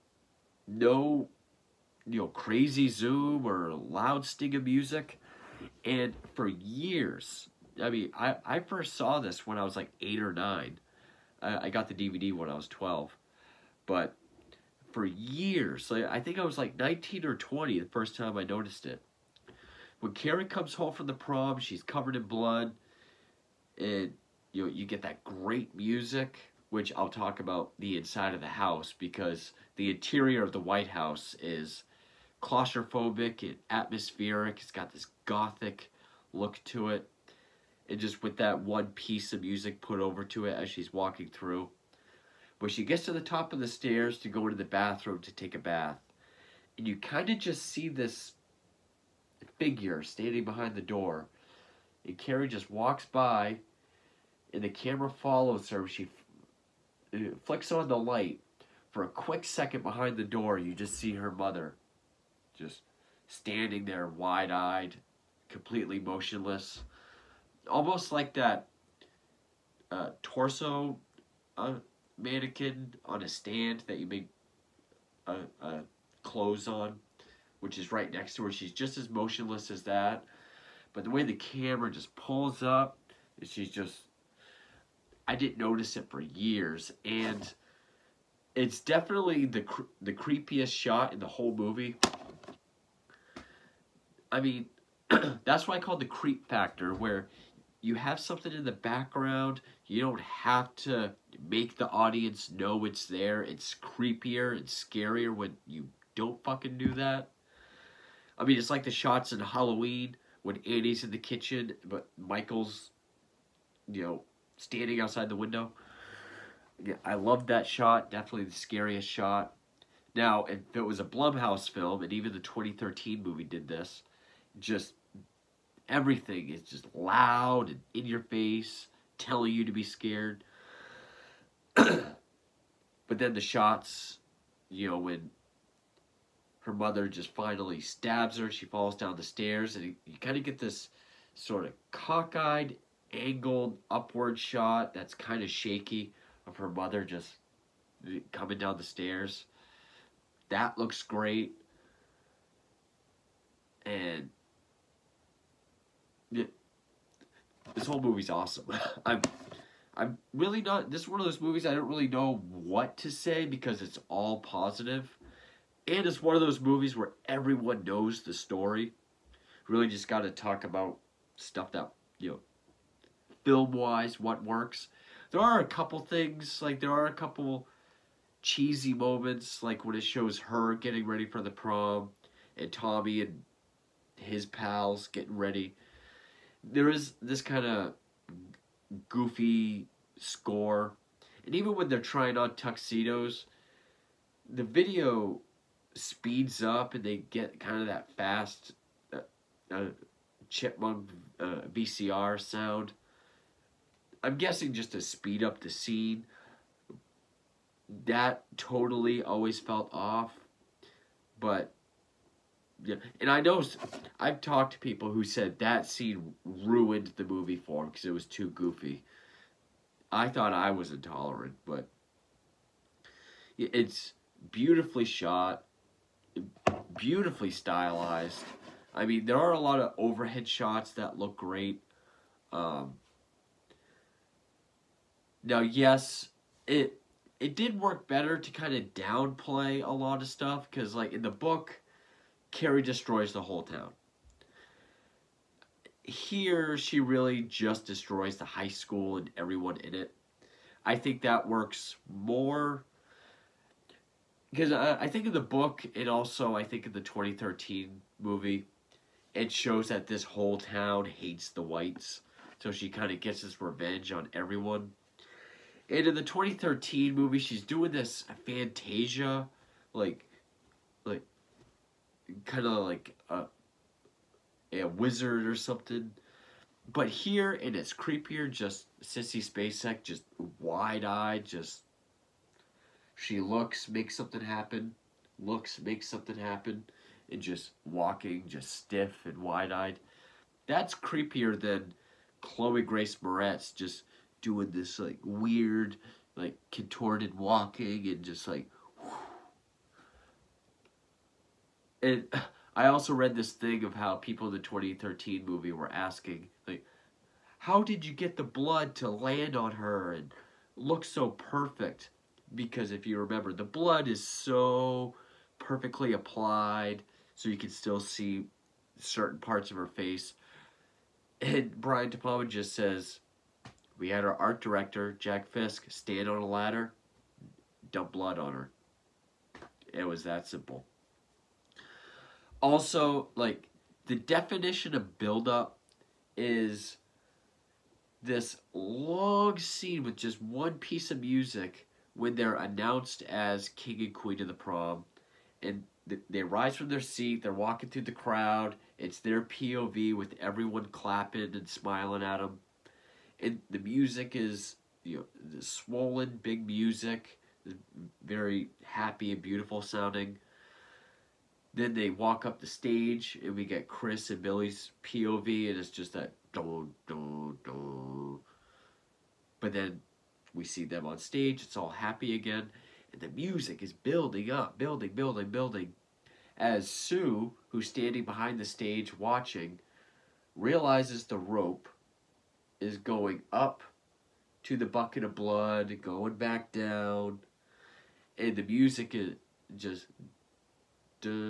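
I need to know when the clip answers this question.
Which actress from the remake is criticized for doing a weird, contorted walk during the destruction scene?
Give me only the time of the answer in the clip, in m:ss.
4:52.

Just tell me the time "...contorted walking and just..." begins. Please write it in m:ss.
4:56.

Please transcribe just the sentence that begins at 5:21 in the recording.
And Brian De Palma just says, we had our art director, Jack Fisk, stand on a ladder, dump blood on her.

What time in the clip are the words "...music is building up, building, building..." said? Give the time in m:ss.
6:13.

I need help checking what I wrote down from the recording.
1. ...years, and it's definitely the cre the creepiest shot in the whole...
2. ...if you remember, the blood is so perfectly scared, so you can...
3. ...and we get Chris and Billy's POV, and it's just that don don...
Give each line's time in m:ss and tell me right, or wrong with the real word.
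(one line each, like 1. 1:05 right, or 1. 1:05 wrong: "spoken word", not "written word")
1. 1:26 right
2. 5:12 wrong: "applied", not "scared"
3. 6:03 right.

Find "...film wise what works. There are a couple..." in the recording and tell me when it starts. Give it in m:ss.
2:53.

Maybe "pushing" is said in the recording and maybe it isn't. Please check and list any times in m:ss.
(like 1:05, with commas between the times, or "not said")
not said.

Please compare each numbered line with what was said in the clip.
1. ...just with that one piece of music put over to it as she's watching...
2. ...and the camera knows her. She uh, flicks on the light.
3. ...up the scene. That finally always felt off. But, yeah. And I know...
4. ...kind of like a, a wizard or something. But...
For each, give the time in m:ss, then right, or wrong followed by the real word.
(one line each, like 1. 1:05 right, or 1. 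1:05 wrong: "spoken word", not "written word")
1. 0:37 wrong: "walking", not "watching"
2. 0:54 wrong: "follows", not "knows"
3. 3:25 wrong: "totally", not "finally"
4. 4:32 right.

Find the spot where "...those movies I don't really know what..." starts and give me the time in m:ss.
2:41.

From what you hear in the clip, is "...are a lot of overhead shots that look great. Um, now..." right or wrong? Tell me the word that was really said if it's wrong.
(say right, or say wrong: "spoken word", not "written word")
right.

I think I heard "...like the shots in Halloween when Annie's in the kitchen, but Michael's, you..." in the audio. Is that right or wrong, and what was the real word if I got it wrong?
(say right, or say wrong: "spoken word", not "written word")
right.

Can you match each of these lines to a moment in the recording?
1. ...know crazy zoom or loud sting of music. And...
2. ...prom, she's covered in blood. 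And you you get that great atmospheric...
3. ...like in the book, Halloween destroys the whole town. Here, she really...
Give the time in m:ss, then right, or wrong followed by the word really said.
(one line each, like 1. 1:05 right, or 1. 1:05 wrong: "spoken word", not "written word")
1. 0:02 right
2. 0:21 wrong: "music", not "atmospheric"
3. 4:00 wrong: "Carrie", not "Halloween".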